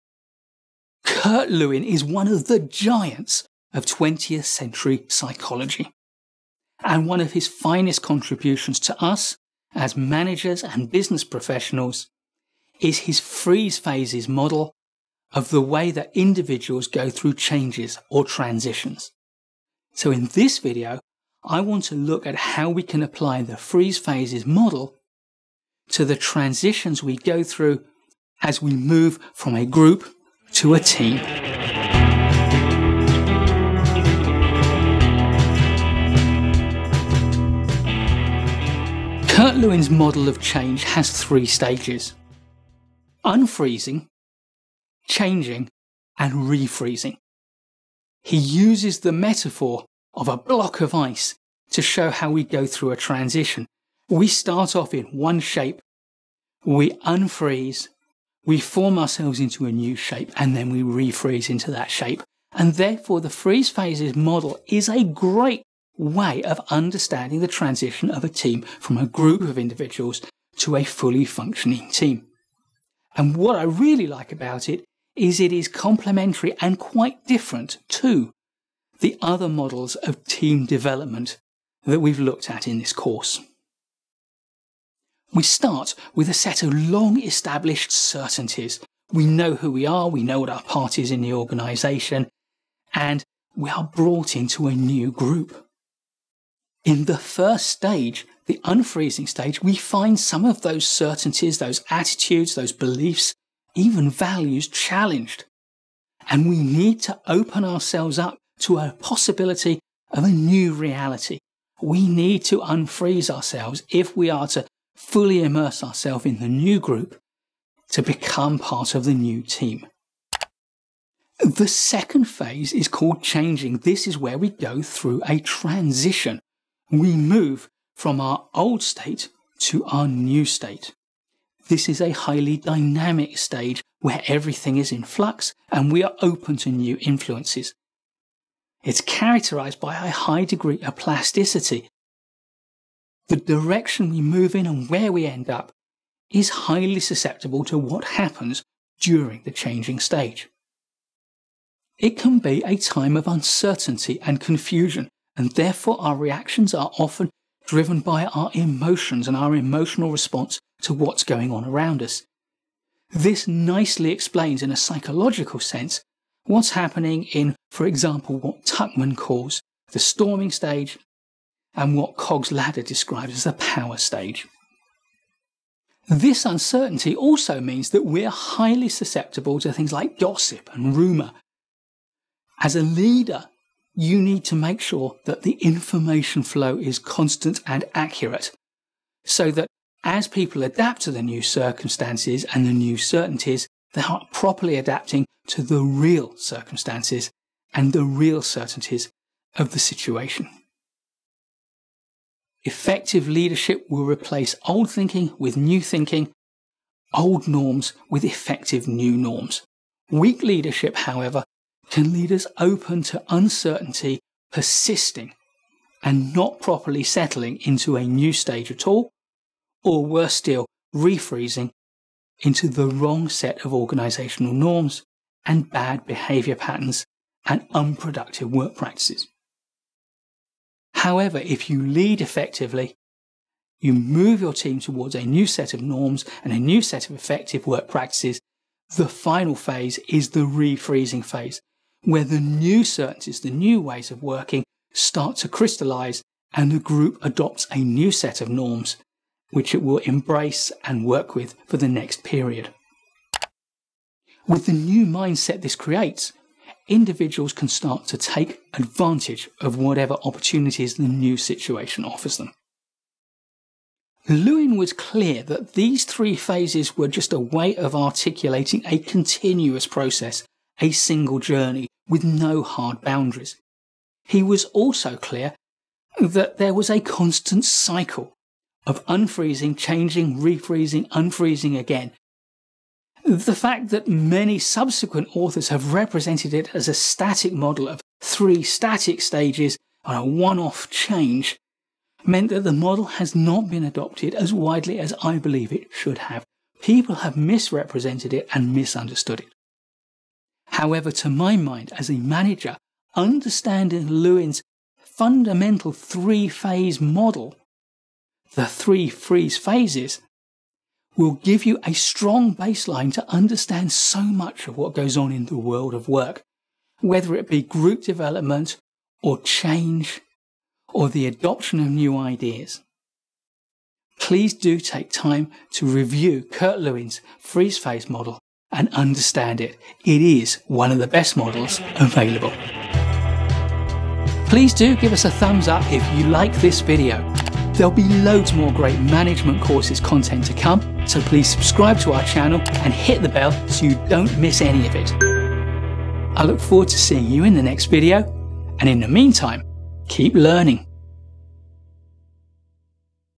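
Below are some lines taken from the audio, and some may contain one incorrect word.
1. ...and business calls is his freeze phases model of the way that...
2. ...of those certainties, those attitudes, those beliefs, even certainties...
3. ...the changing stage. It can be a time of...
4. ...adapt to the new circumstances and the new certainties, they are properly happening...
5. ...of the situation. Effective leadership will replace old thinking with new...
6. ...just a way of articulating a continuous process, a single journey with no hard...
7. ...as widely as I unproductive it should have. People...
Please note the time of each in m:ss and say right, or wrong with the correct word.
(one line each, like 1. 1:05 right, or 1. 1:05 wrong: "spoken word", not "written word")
1. 0:10 wrong: "professionals", not "calls"
2. 1:40 wrong: "values", not "certainties"
3. 2:29 right
4. 3:10 wrong: "adapting", not "happening"
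5. 3:19 right
6. 4:27 right
7. 4:54 wrong: "believe", not "unproductive".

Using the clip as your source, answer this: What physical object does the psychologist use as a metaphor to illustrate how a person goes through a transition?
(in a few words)
A block of ice.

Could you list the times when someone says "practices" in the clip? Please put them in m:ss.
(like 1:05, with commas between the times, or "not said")
3:48, 3:57.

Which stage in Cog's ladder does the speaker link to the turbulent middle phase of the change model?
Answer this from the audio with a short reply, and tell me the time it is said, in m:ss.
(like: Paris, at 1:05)
The power stage, at 2:53.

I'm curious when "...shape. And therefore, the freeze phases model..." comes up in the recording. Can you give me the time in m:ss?
1:01.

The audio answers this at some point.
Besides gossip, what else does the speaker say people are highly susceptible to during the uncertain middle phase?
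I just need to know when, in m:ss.
3:00.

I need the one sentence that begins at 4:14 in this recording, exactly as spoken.
With the new mindset this creates, individuals can start to take advantage of whatever opportunities the new situation offers them.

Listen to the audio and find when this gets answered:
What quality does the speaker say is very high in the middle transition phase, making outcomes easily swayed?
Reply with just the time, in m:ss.
2:20.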